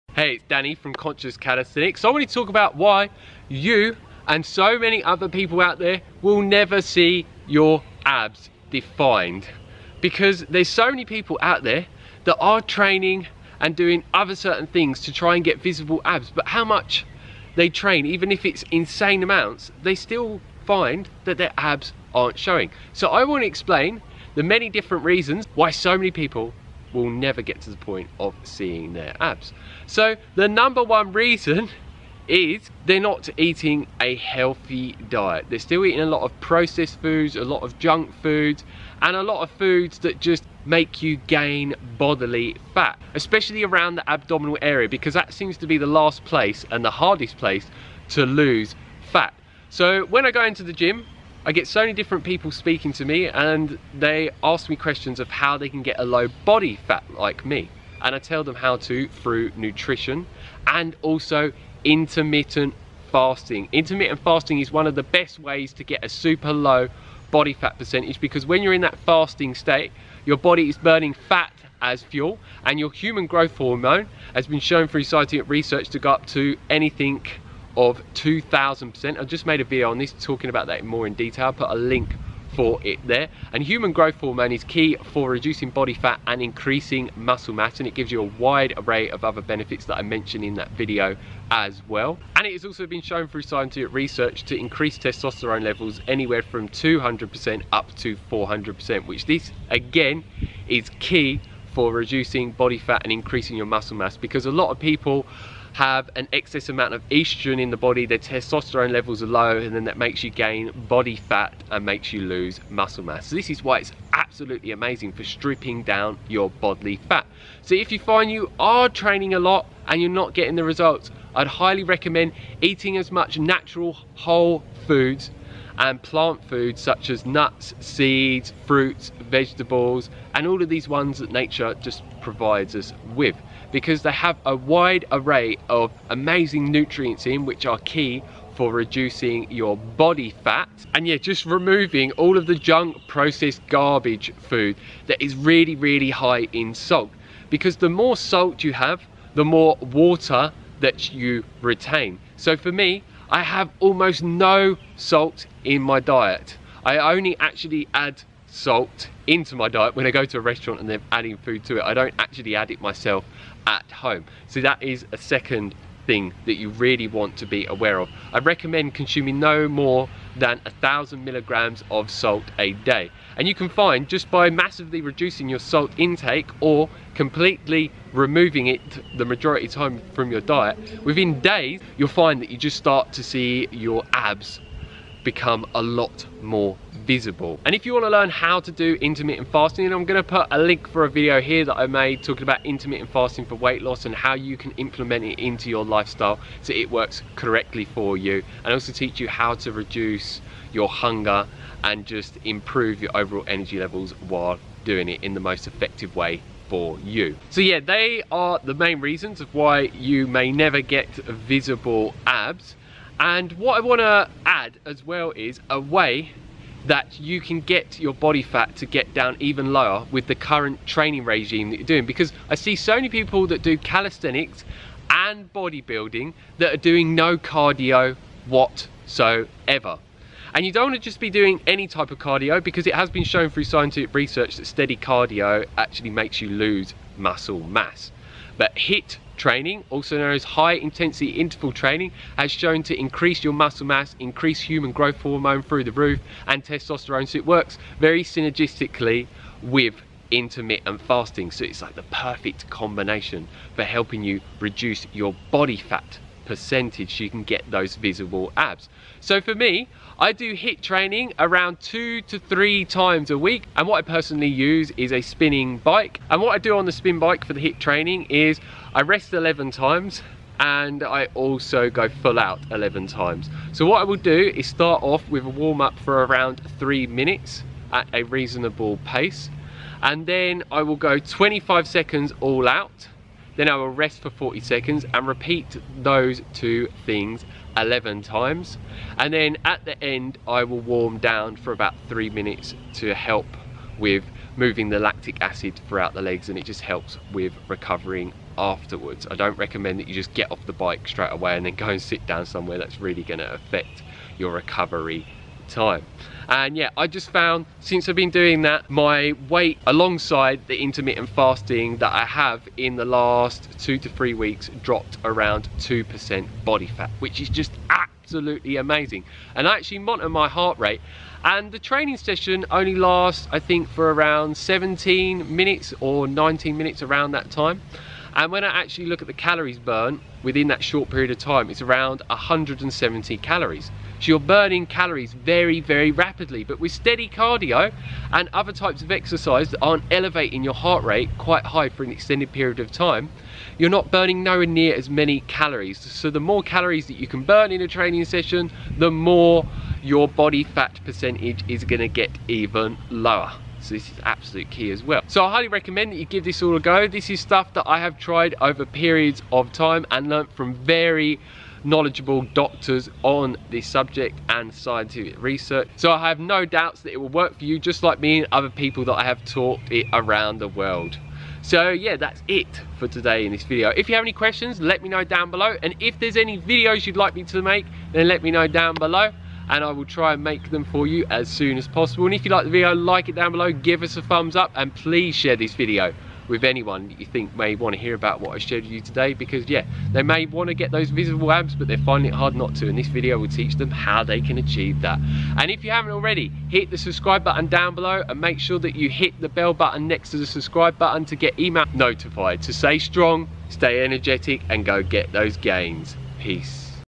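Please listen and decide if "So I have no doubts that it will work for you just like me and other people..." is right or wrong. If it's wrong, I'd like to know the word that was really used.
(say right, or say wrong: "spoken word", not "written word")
right.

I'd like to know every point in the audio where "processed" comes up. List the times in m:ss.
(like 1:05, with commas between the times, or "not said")
0:36, 2:23.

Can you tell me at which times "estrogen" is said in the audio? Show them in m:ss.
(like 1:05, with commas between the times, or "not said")
1:47.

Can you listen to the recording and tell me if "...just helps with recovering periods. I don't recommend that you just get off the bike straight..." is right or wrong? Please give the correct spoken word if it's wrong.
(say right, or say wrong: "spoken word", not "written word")
wrong: "afterwards", not "periods".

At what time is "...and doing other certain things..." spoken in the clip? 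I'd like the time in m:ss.
0:13.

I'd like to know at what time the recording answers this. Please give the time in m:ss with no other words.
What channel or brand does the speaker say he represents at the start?
0:00.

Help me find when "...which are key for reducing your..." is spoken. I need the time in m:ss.
2:17.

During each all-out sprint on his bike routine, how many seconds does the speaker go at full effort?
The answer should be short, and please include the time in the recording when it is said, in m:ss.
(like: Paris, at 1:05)
25 seconds, at 4:41.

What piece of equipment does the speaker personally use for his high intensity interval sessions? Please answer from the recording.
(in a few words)
a spinning bike.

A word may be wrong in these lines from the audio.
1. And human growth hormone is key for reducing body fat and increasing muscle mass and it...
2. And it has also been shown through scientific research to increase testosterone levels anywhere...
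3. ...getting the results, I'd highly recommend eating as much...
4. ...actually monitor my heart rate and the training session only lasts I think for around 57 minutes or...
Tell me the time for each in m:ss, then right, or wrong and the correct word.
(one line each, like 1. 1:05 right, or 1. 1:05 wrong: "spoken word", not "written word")
1. 1:23 right
2. 1:32 right
3. 2:00 right
4. 5:19 wrong: "17", not "57".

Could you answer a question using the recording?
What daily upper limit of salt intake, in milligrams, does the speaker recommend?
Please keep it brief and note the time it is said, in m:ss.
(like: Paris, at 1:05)
1000 milligrams, at 2:50.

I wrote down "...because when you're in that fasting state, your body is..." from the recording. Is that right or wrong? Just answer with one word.
right.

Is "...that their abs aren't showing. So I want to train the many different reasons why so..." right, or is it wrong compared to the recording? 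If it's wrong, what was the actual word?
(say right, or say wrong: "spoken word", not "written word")
wrong: "explain", not "train".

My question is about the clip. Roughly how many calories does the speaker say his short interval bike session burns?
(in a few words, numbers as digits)
170.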